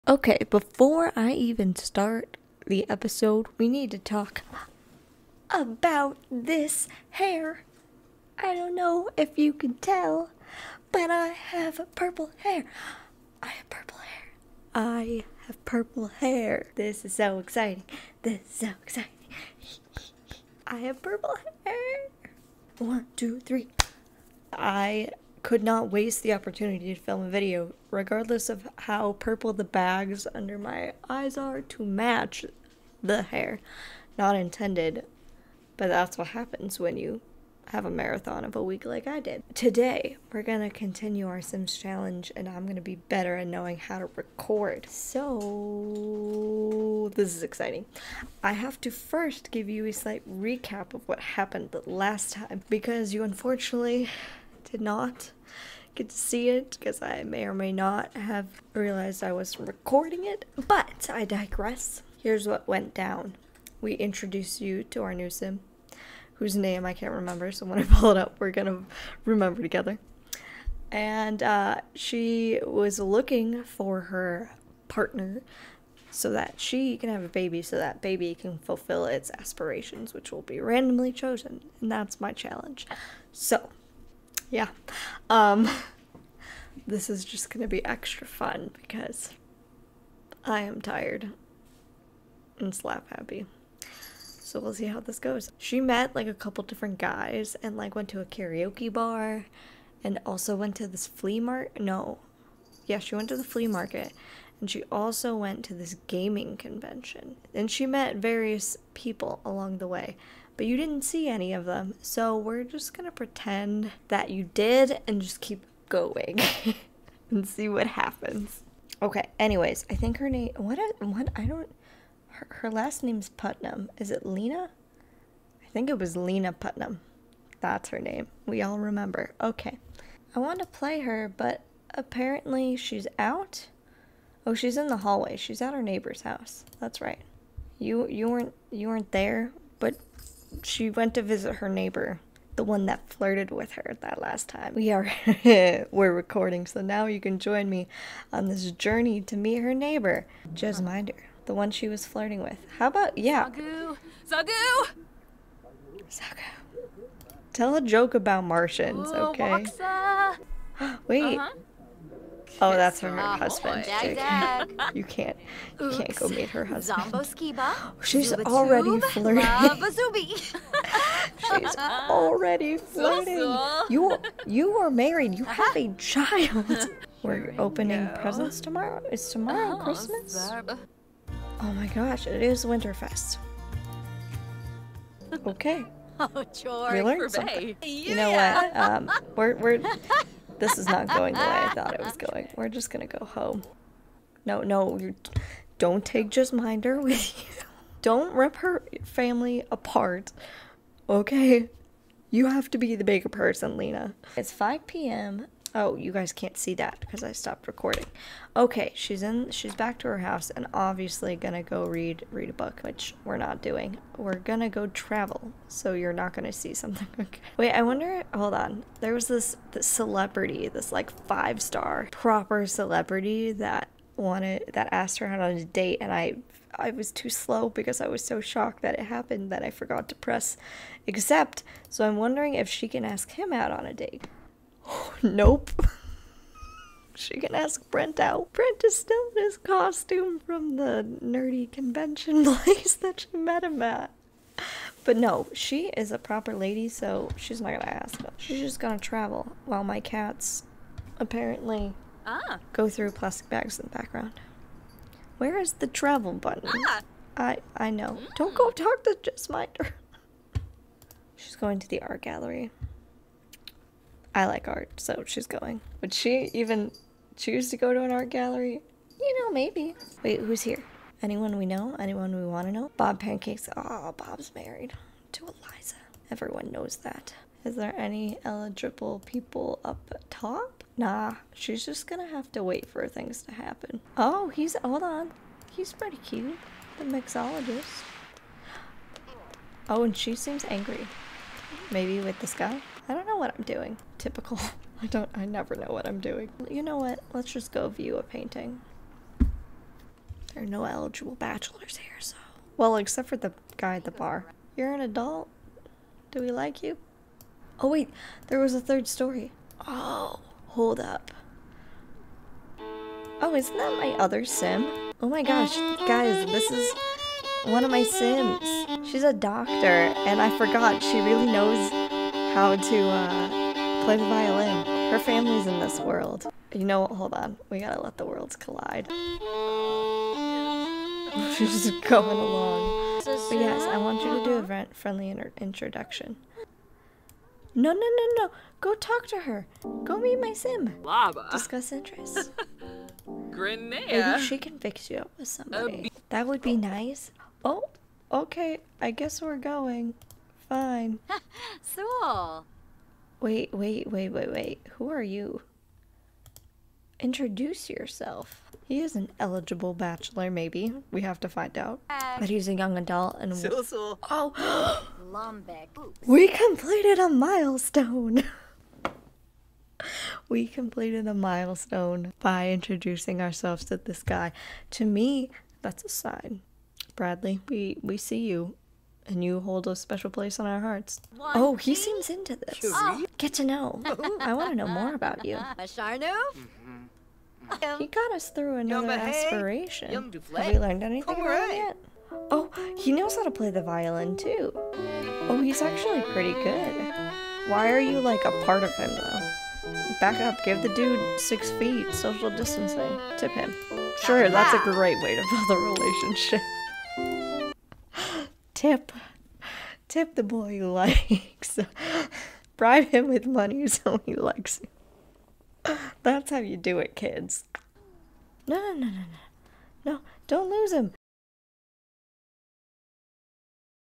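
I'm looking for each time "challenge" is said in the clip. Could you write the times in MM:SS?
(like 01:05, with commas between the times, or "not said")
00:41, 01:22.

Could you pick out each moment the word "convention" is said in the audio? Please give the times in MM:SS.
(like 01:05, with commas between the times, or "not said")
01:46, 04:01.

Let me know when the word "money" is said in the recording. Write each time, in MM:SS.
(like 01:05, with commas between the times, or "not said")
06:53.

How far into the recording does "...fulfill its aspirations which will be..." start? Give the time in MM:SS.
01:18.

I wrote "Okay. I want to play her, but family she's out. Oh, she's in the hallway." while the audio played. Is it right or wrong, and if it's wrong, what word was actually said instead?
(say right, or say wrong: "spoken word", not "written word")
wrong: "apparently", not "family".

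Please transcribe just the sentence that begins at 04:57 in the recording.
Let's just go view a painting.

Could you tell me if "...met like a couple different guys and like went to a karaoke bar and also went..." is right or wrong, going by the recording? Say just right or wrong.
right.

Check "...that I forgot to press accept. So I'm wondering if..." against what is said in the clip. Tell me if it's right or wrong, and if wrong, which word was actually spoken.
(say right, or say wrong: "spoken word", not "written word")
right.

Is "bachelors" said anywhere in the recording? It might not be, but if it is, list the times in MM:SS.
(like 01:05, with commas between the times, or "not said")
05:01, 05:59.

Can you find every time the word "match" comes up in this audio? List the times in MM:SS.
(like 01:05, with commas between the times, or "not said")
00:31.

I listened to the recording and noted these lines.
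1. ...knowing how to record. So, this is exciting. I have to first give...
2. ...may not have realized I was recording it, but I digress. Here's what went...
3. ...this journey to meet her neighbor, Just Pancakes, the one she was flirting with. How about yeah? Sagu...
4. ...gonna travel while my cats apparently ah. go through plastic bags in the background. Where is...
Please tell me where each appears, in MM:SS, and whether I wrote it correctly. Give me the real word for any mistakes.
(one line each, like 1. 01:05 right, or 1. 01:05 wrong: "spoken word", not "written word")
1. 00:43 right
2. 00:57 right
3. 02:28 wrong: "Minder", not "Pancakes"
4. 04:08 right.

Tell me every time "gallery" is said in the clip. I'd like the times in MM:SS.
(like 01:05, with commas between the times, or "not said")
04:22, 04:28.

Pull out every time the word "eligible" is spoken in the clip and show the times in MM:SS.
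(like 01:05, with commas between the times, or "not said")
04:38, 05:00, 05:59.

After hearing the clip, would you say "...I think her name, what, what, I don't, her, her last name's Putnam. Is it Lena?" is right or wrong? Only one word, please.
right.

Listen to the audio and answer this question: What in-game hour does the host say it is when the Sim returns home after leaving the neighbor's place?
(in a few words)
5 p.m.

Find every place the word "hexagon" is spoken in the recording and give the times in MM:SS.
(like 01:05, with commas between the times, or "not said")
not said.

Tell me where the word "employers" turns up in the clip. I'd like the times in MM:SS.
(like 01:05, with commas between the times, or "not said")
not said.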